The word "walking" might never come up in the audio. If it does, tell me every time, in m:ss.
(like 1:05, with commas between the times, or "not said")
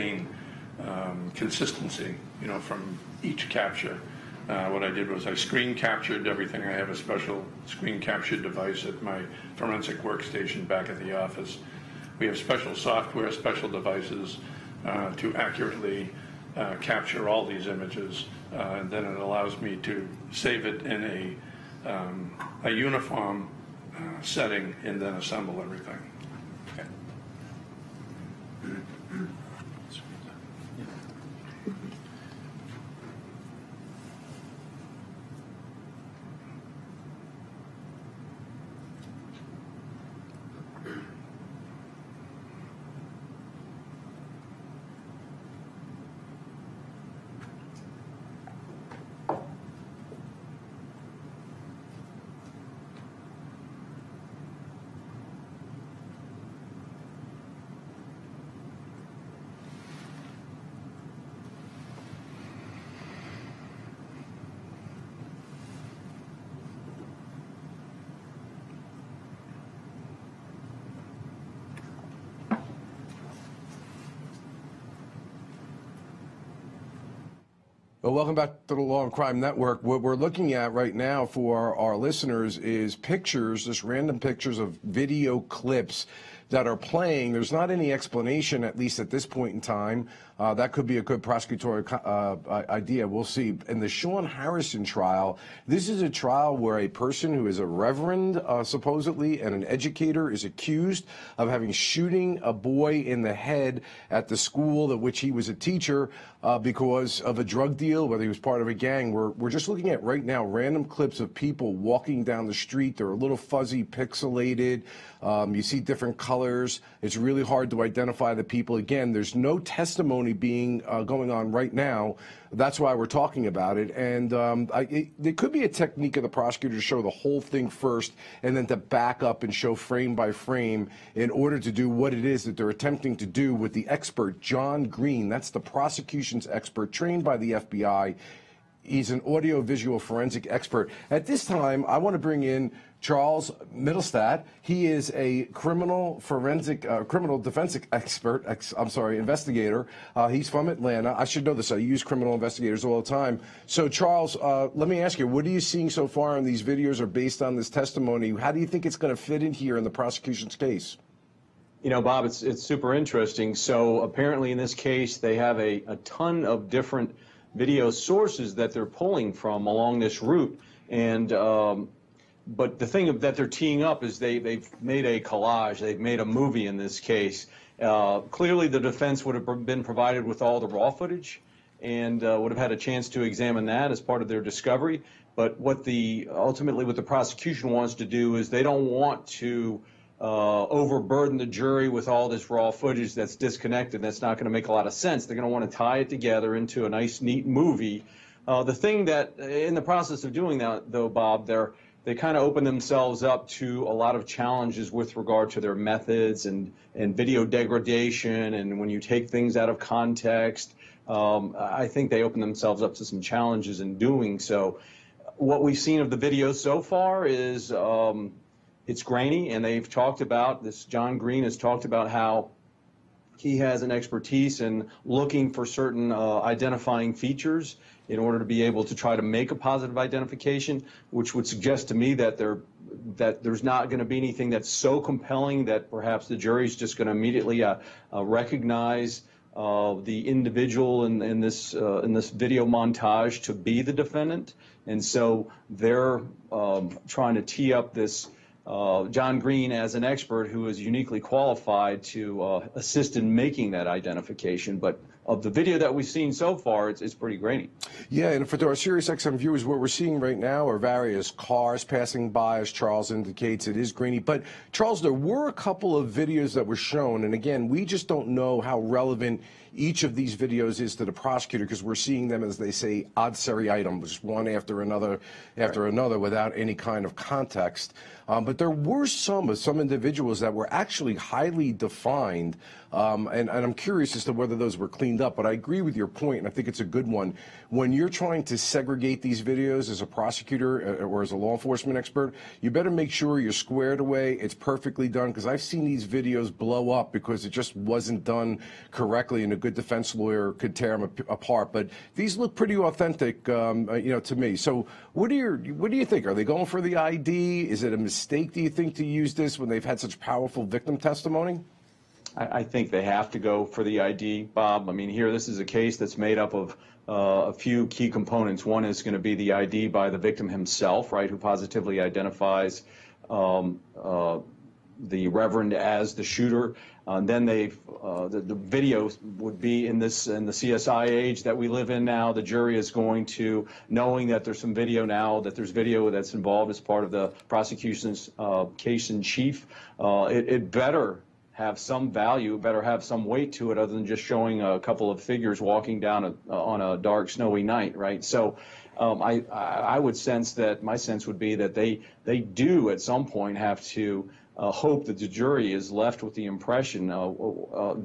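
1:51, 5:45.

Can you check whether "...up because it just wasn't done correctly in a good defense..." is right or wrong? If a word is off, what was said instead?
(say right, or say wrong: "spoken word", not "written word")
right.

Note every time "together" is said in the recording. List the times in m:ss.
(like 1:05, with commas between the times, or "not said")
3:16.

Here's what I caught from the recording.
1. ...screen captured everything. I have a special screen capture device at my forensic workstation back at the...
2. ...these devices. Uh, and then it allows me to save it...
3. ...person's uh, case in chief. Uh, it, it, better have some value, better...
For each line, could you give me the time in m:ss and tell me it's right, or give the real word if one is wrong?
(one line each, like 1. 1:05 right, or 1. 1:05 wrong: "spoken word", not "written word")
1. 0:05 right
2. 0:17 wrong: "images", not "devices"
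3. 5:37 wrong: "prosecution", not "person".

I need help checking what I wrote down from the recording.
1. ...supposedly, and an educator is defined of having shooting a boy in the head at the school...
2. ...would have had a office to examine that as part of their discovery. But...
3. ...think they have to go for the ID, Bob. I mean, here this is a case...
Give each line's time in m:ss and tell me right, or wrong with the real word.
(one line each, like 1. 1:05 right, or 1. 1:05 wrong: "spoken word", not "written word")
1. 1:38 wrong: "accused", not "defined"
2. 3:02 wrong: "chance", not "office"
3. 5:12 right.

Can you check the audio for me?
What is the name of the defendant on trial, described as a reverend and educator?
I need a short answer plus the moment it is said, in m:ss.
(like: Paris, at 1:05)
Shaun Harrison, at 1:33.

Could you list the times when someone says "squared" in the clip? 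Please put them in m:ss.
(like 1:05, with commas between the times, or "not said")
4:53.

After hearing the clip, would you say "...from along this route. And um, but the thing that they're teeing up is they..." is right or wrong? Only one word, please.
right.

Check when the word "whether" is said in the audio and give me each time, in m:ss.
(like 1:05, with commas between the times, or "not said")
1:48, 4:44.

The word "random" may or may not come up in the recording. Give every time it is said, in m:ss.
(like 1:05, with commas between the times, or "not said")
1:23, 1:50.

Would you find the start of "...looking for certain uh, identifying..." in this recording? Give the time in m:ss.
3:45.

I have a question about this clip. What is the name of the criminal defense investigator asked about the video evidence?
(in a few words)
Charles Mittelstadt.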